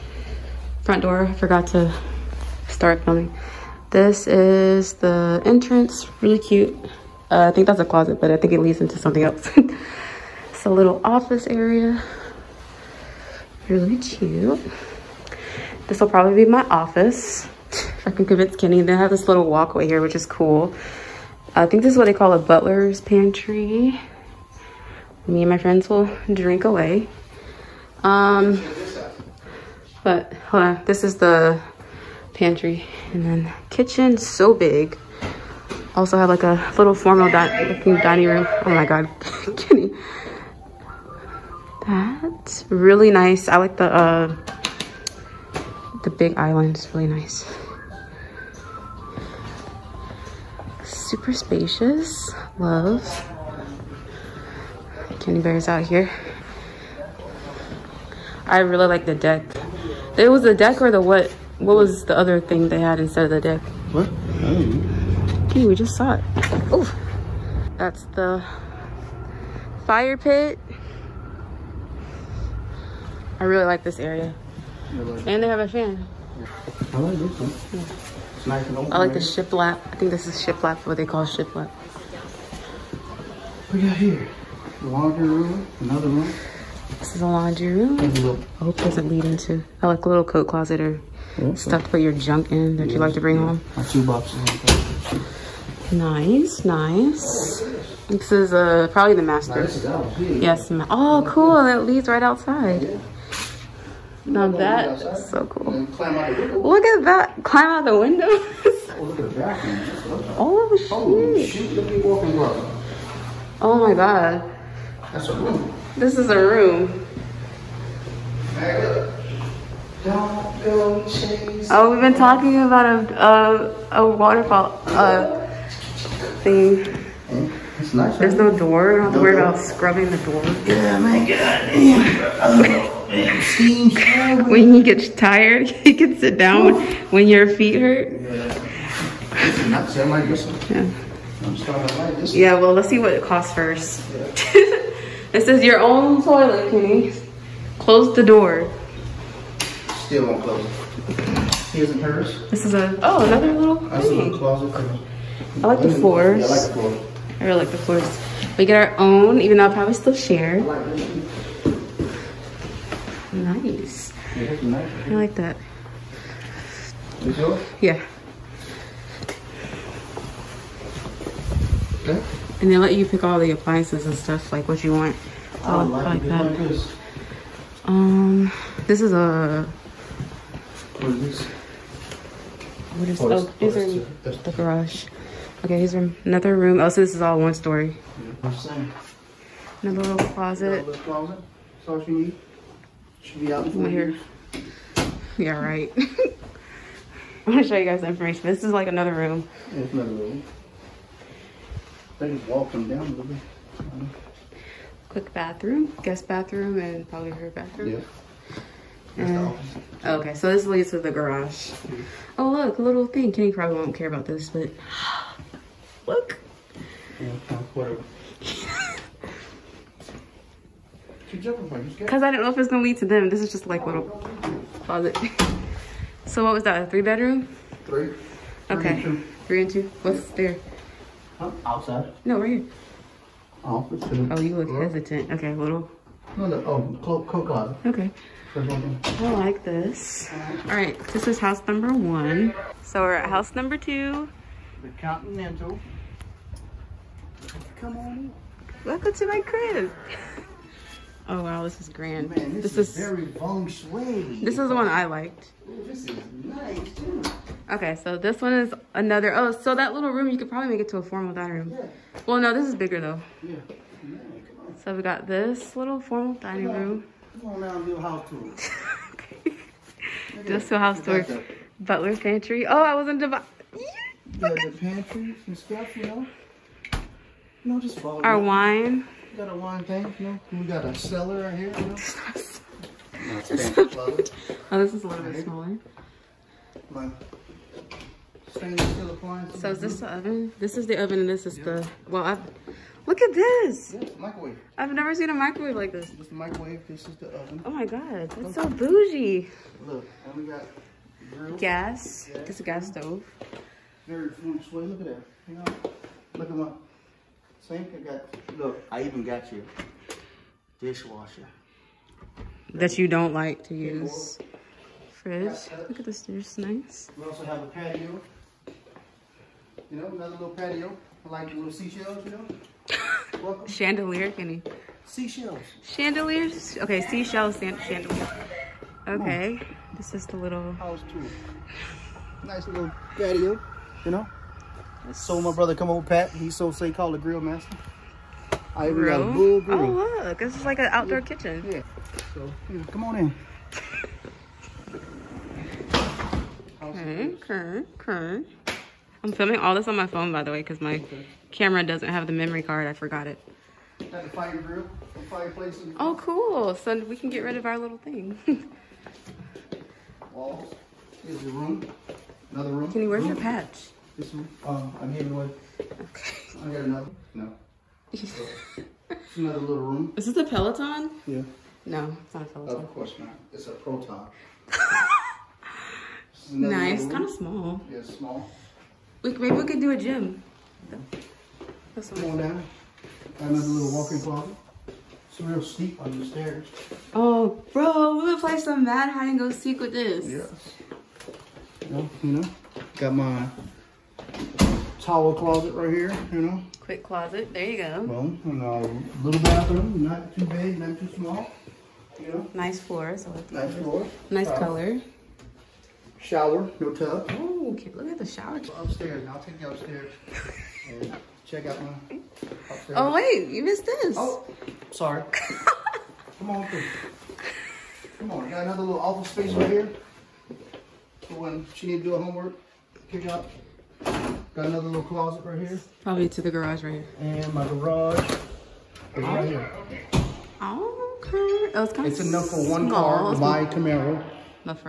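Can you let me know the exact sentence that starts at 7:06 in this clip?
Probably to the garage right here.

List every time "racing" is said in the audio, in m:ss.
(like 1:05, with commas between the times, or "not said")
not said.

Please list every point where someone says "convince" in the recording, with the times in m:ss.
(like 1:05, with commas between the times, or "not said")
0:18.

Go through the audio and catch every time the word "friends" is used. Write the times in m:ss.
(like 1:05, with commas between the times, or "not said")
0:25.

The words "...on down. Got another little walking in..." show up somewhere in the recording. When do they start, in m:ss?
6:22.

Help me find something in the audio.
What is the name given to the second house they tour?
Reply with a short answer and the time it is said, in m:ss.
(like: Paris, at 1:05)
The Continental, at 4:04.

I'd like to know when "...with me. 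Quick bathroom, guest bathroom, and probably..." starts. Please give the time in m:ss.
3:23.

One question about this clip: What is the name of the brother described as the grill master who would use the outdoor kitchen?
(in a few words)
Pat.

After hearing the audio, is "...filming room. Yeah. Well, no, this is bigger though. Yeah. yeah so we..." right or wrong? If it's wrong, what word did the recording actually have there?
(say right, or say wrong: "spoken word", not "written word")
wrong: "dining", not "filming".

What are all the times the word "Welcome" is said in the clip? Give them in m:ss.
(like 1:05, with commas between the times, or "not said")
4:08, 5:23.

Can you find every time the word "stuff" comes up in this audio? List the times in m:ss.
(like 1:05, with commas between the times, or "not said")
1:31, 2:54, 4:35.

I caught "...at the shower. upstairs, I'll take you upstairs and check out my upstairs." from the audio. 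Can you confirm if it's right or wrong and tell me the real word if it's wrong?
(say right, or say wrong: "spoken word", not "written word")
right.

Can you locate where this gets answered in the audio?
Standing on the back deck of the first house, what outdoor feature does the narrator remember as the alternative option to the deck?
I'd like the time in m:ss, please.
1:06.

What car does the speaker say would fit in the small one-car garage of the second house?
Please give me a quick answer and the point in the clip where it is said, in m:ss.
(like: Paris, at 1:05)
Camaro, at 7:13.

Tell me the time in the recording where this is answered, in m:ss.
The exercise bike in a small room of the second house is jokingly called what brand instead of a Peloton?
6:13.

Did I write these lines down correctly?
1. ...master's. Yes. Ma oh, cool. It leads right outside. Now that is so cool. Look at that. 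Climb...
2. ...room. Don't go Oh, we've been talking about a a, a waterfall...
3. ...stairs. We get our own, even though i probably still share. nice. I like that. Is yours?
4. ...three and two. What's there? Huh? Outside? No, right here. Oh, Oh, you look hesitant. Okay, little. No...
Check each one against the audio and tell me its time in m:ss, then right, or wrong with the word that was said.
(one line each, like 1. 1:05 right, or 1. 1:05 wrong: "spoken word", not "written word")
1. 1:39 right
2. 1:56 right
3. 2:37 wrong: "floors", not "stairs"
4. 3:49 right.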